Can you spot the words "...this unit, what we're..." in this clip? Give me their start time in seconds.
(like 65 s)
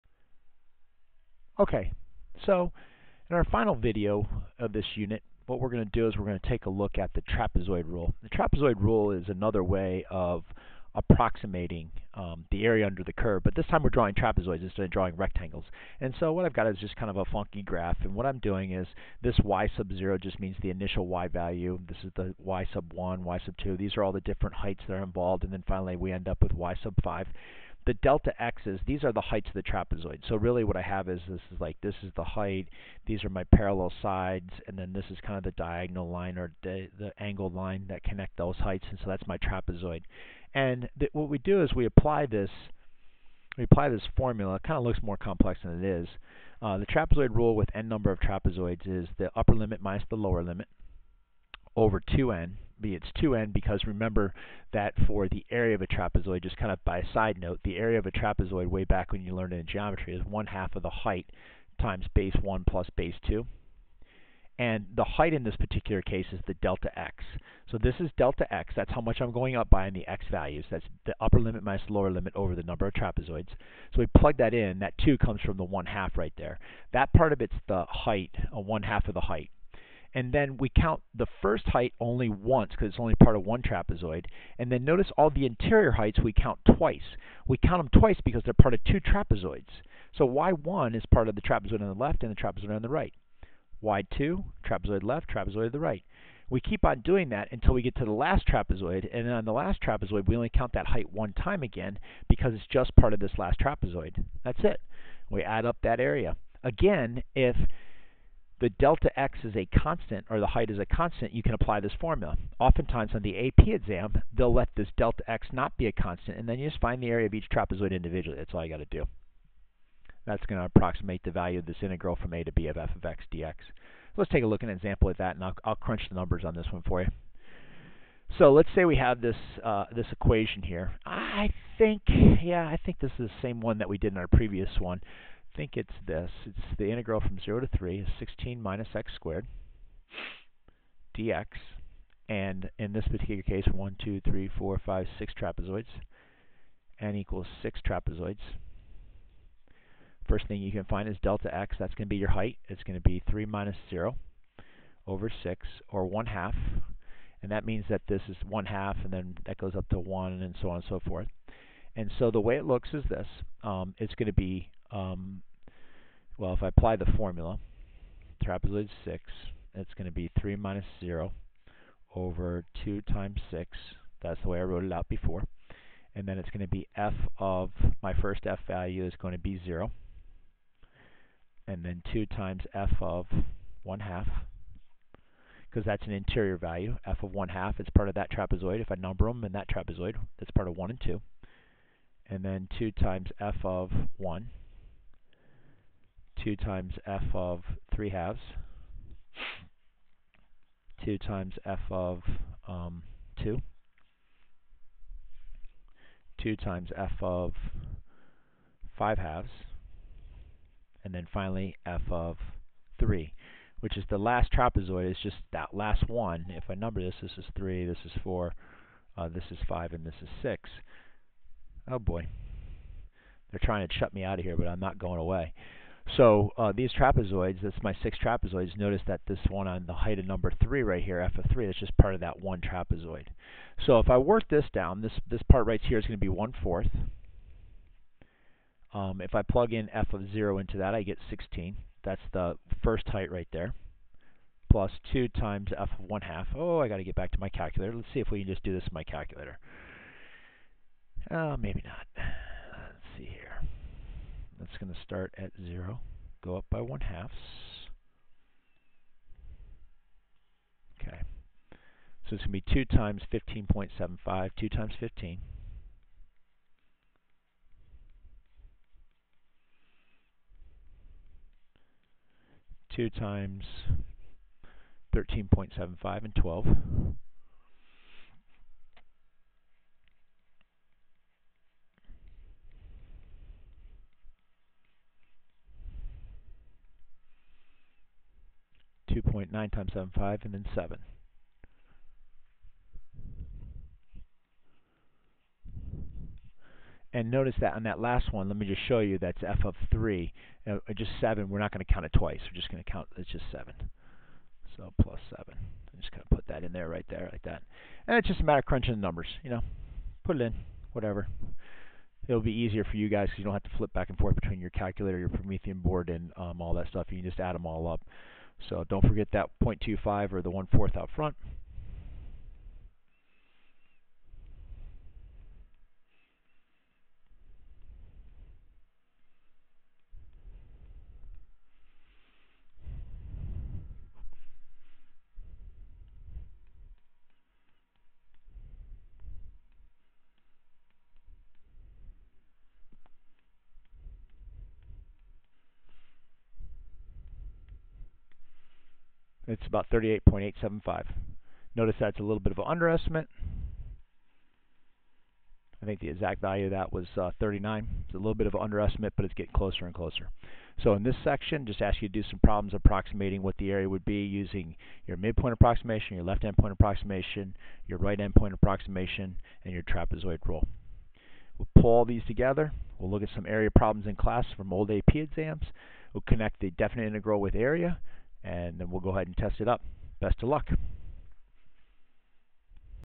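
4 s.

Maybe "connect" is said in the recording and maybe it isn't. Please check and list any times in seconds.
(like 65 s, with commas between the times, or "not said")
38 s, 376 s.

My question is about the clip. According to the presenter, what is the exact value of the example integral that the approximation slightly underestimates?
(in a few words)
39.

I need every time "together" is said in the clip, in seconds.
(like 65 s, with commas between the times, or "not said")
372 s.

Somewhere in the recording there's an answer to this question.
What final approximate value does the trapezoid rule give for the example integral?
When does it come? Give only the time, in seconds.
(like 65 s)
349 s.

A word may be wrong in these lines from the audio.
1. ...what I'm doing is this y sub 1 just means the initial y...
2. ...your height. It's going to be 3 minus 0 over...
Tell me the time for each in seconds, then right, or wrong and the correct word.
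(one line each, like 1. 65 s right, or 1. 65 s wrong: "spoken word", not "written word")
1. 18 s wrong: "0", not "1"
2. 152 s right.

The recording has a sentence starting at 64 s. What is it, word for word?
And the height in this particular case is the delta x.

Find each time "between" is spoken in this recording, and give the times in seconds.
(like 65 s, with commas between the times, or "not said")
314 s.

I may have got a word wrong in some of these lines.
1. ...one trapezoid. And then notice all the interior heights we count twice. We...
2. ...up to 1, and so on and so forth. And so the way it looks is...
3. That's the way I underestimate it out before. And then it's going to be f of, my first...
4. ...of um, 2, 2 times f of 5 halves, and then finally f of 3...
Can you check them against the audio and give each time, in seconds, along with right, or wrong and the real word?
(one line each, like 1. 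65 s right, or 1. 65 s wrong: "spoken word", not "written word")
1. 83 s right
2. 159 s right
3. 174 s wrong: "wrote", not "underestimate"
4. 201 s right.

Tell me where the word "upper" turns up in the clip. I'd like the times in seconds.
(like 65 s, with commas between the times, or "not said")
49 s, 71 s.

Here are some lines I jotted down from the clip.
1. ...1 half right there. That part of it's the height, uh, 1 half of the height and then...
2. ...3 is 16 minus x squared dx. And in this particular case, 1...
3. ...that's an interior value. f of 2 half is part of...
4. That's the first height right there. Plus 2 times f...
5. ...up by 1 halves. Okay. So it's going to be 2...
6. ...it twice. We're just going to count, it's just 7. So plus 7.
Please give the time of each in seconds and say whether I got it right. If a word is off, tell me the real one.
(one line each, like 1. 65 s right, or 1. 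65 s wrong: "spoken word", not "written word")
1. 75 s right
2. 137 s right
3. 185 s wrong: "1", not "2"
4. 242 s right
5. 256 s right
6. 302 s right.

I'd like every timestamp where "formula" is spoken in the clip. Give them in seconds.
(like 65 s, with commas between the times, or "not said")
44 s, 111 s, 167 s.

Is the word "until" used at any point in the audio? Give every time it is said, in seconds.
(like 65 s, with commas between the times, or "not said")
97 s.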